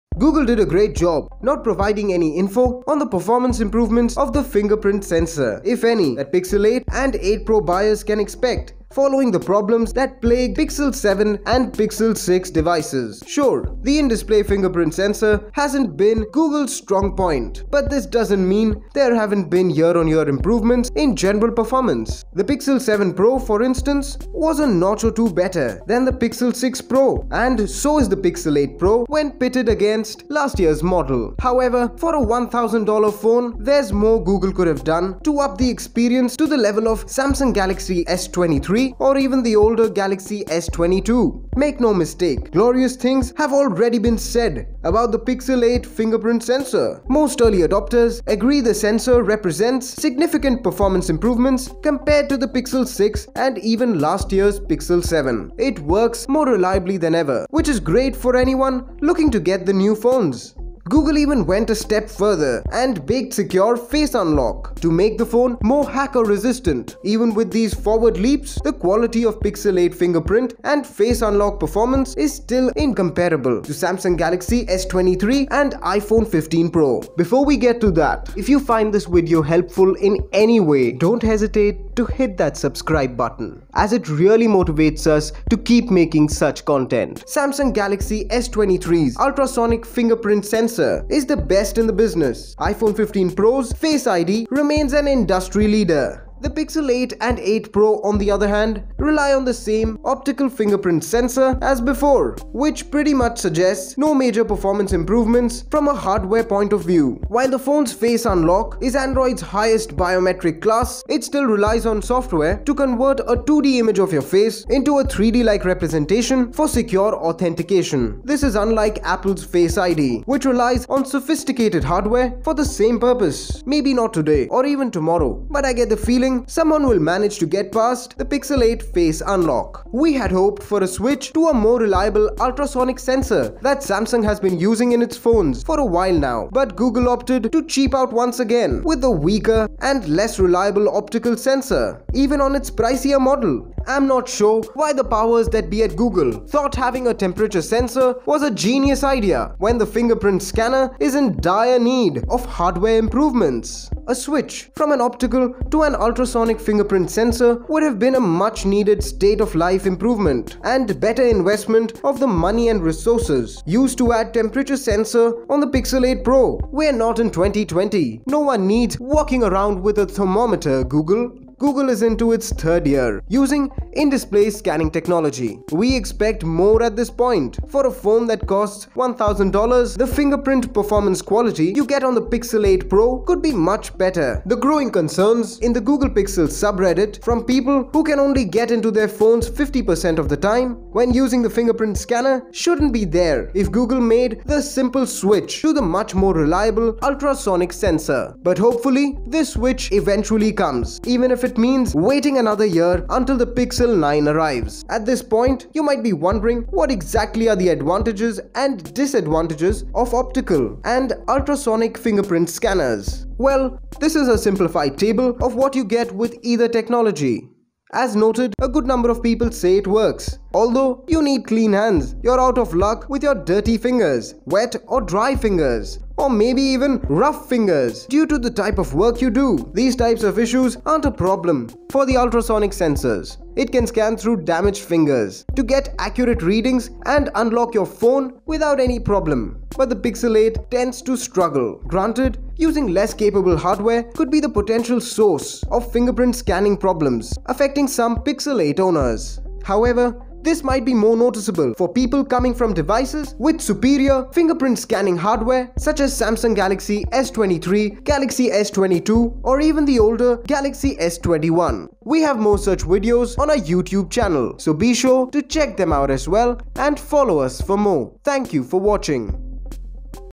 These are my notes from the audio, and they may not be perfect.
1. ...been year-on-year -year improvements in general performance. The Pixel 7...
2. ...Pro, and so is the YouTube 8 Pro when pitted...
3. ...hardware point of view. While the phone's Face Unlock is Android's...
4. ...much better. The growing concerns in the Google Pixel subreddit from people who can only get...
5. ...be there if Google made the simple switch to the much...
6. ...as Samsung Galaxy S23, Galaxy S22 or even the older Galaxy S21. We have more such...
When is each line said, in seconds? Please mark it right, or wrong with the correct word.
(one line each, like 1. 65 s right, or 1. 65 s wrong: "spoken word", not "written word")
1. 19 s right
2. 26 s wrong: "Pixel", not "YouTube"
3. 105 s right
4. 183 s right
5. 192 s right
6. 255 s right.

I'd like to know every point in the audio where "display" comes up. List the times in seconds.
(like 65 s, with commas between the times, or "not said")
13 s, 173 s.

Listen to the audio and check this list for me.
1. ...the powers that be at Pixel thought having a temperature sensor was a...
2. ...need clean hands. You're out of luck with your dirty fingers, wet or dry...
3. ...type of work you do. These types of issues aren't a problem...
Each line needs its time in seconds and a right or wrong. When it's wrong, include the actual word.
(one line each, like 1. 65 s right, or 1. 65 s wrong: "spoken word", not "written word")
1. 144 s wrong: "Google", not "Pixel"
2. 221 s right
3. 228 s right.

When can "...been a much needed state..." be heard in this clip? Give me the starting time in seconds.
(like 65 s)
157 s.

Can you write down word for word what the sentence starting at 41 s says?
Make no mistake, glorious things have already been said about the Pixel 8 fingerprint sensor.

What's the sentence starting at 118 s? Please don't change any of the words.
This is unlike Apple's Face ID, which relies on sophisticated hardware for the same purpose.